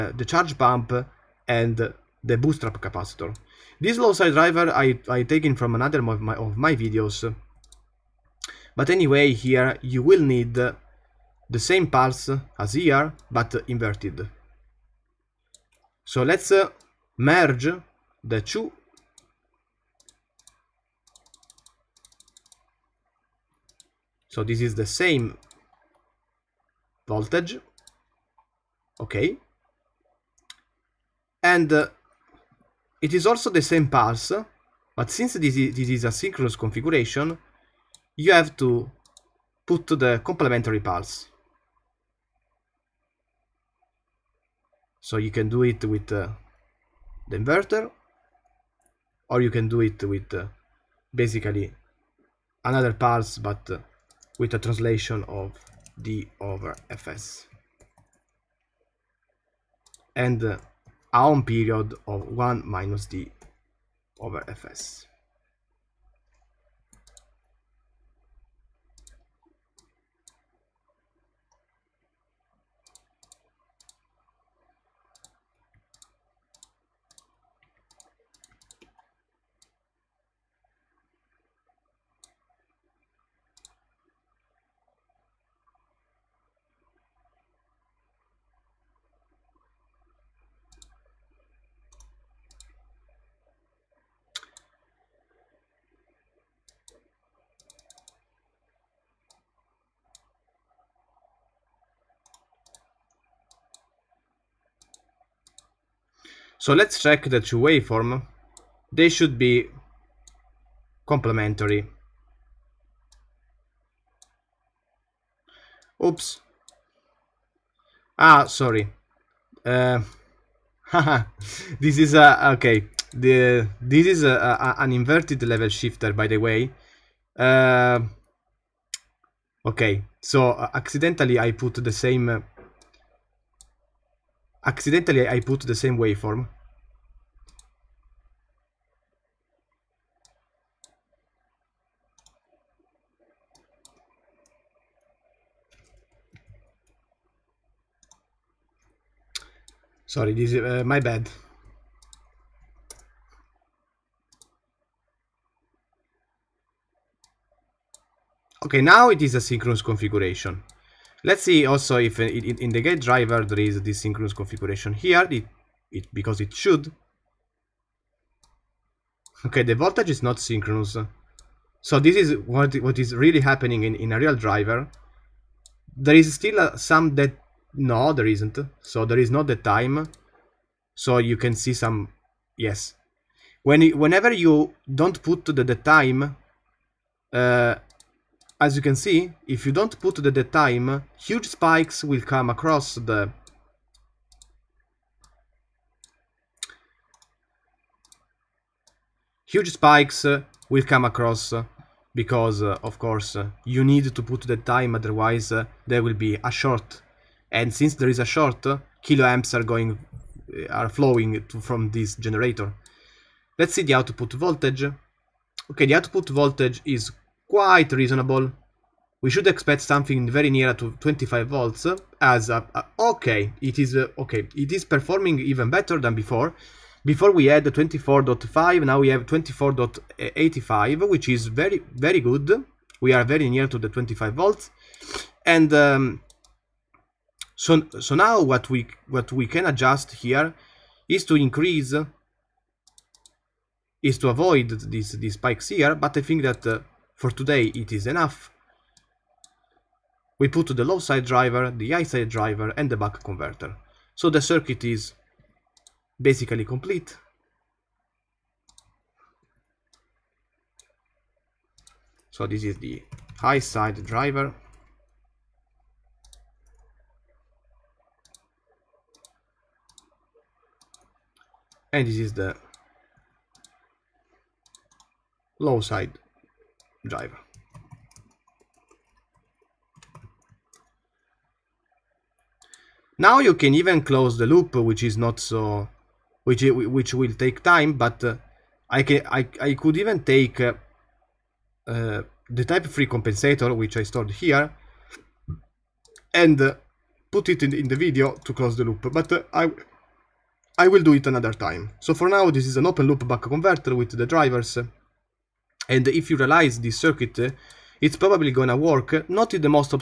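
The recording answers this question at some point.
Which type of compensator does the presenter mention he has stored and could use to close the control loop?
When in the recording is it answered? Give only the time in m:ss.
4:52.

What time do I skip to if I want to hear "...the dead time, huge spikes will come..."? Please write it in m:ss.
3:10.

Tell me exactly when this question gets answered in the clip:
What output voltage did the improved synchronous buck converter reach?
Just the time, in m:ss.
3:49.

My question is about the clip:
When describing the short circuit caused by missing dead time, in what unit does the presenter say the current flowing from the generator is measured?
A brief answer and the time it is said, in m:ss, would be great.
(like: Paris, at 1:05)
kiloamps, at 3:29.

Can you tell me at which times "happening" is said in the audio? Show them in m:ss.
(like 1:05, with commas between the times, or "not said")
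2:53.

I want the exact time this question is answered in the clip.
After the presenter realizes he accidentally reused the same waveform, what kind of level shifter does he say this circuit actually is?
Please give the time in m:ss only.
2:04.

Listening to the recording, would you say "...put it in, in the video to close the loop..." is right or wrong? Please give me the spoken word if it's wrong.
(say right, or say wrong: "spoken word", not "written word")
right.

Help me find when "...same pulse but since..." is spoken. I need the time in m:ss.
0:33.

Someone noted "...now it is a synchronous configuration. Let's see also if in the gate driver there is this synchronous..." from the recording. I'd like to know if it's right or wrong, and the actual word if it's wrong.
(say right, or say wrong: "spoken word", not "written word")
right.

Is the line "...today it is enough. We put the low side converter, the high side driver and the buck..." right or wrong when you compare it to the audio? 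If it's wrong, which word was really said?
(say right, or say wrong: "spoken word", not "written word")
wrong: "driver", not "converter".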